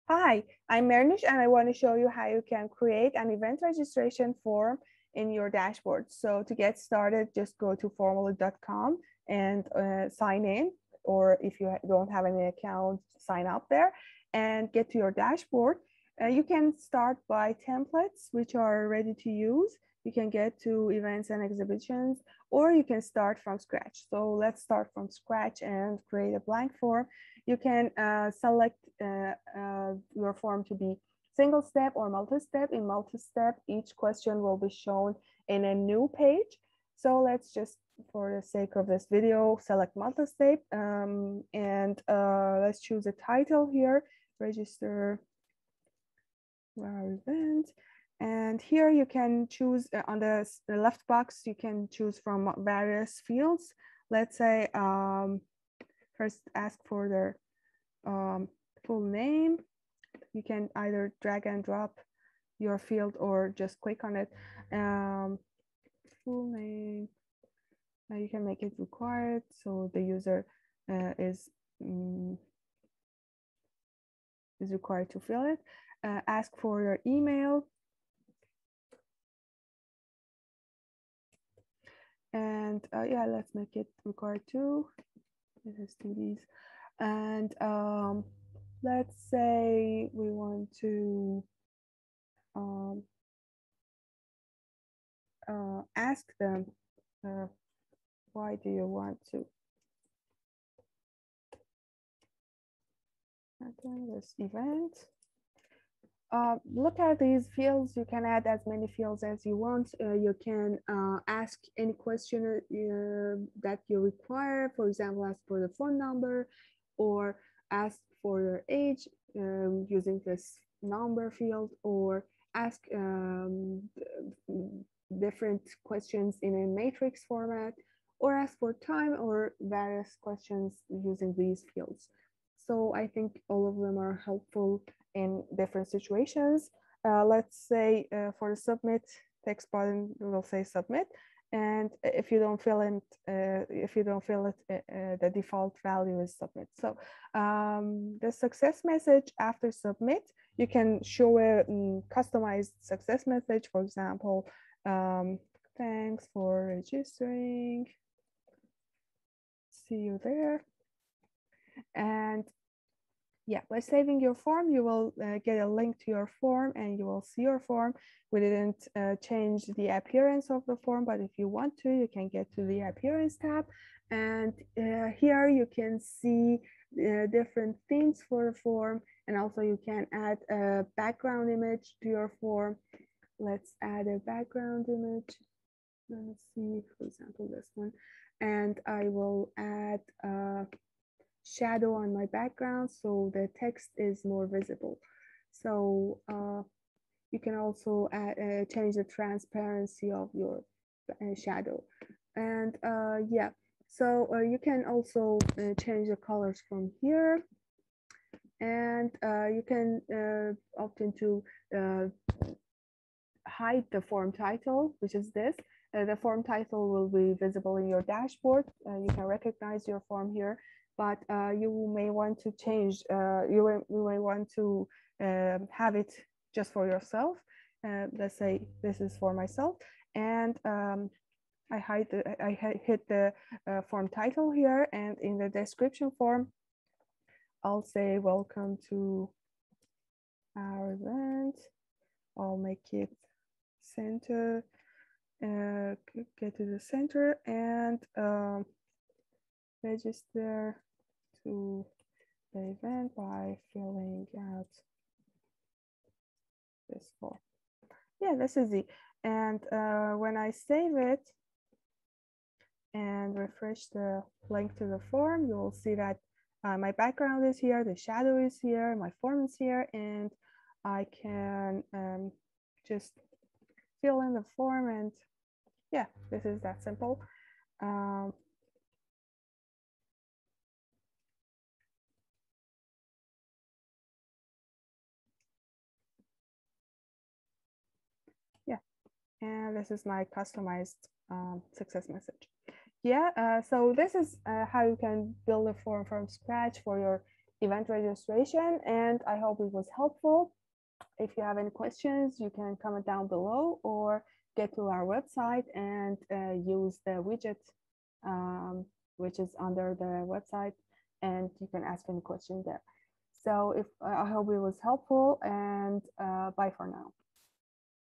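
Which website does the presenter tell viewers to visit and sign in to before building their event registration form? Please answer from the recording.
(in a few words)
formaloo.com.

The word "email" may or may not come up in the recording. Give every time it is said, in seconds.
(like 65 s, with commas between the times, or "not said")
77 s.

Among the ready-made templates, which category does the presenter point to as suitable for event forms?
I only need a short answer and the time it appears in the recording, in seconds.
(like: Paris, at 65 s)
Events and exhibitions, at 20 s.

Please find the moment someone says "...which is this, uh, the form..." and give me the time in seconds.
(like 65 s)
214 s.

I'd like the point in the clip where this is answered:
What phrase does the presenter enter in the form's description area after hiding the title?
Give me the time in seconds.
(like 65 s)
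238 s.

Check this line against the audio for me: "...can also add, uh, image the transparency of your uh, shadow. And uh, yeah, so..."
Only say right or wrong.
wrong.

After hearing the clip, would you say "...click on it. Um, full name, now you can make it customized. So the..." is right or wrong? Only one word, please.
wrong.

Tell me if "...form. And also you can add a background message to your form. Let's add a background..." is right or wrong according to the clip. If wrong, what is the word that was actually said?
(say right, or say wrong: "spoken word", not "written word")
wrong: "image", not "message".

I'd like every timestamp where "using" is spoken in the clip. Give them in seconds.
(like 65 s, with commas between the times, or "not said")
119 s, 130 s.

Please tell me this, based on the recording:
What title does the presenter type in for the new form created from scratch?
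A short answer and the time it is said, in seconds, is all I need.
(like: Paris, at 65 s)
Register our event, at 44 s.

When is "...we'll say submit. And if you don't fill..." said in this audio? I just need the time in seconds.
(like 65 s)
140 s.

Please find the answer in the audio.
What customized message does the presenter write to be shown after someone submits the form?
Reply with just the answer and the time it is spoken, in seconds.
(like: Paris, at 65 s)
Thanks for registering. See you there., at 155 s.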